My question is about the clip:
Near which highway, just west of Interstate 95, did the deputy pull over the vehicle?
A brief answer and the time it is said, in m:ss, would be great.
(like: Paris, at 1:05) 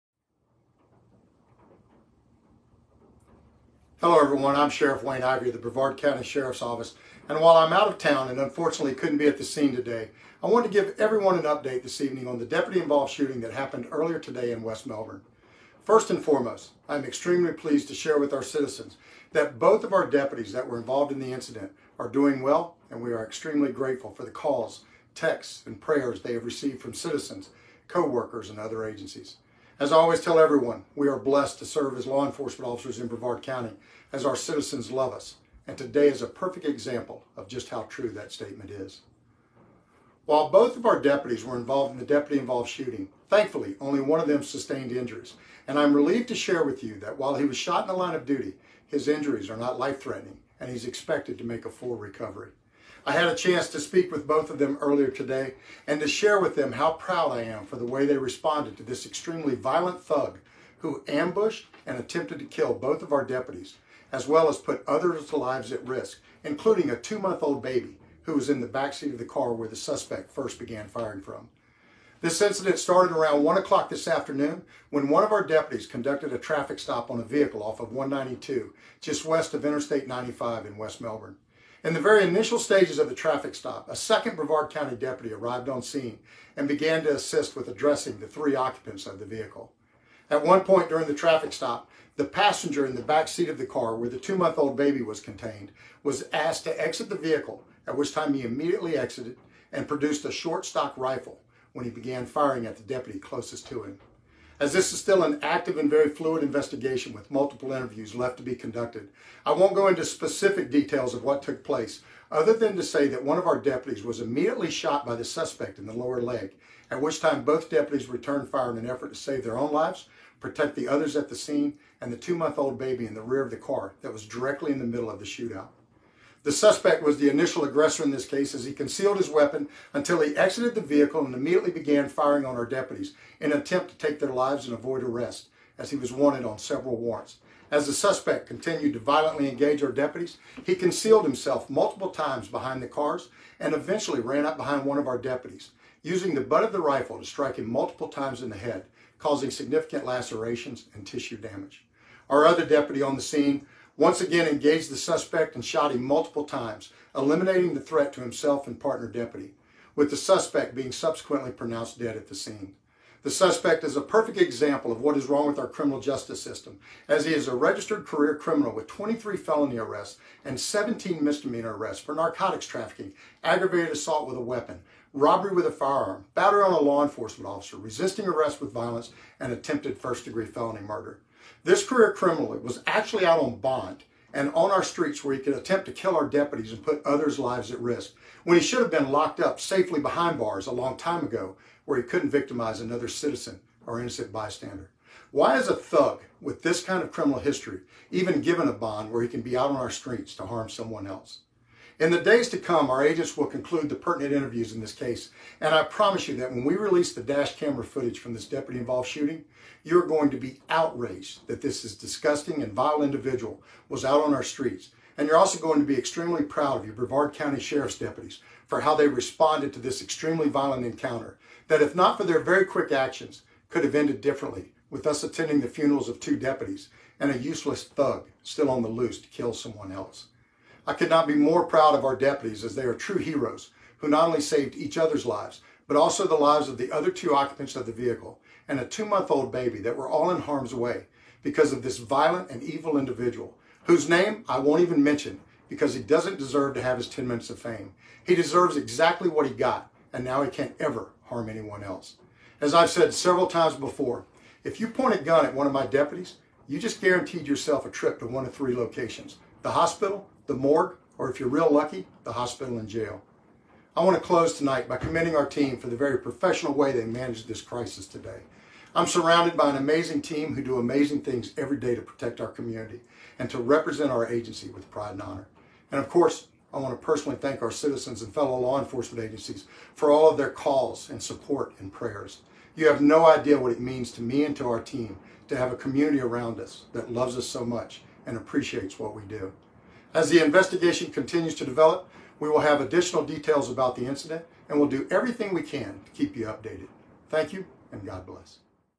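192, at 1:17.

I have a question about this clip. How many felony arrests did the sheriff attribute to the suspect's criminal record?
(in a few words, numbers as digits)
23.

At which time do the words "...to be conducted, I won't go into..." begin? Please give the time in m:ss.
1:48.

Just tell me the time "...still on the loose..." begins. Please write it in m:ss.
3:48.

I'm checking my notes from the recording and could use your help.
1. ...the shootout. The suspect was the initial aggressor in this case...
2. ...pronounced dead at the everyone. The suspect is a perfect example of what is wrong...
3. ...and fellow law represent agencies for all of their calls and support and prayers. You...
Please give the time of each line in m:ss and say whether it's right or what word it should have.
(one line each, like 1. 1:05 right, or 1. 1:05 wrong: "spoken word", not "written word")
1. 2:05 right
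2. 2:41 wrong: "scene", not "everyone"
3. 4:38 wrong: "enforcement", not "represent".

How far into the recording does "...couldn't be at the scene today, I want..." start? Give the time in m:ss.
0:08.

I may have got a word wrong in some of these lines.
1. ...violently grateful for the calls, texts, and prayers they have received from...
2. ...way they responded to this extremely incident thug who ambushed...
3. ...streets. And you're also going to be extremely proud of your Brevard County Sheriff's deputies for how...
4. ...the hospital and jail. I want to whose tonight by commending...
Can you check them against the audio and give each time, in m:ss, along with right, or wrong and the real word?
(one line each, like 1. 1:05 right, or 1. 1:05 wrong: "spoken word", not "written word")
1. 0:23 wrong: "extremely", not "violently"
2. 0:57 wrong: "violent", not "incident"
3. 3:34 right
4. 4:22 wrong: "close", not "whose".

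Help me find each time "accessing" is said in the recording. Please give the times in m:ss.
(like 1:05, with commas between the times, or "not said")
not said.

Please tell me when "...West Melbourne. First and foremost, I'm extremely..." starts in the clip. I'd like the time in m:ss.
0:14.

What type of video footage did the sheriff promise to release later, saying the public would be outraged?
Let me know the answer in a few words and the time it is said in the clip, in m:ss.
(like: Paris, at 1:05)
Dash camera footage, at 3:27.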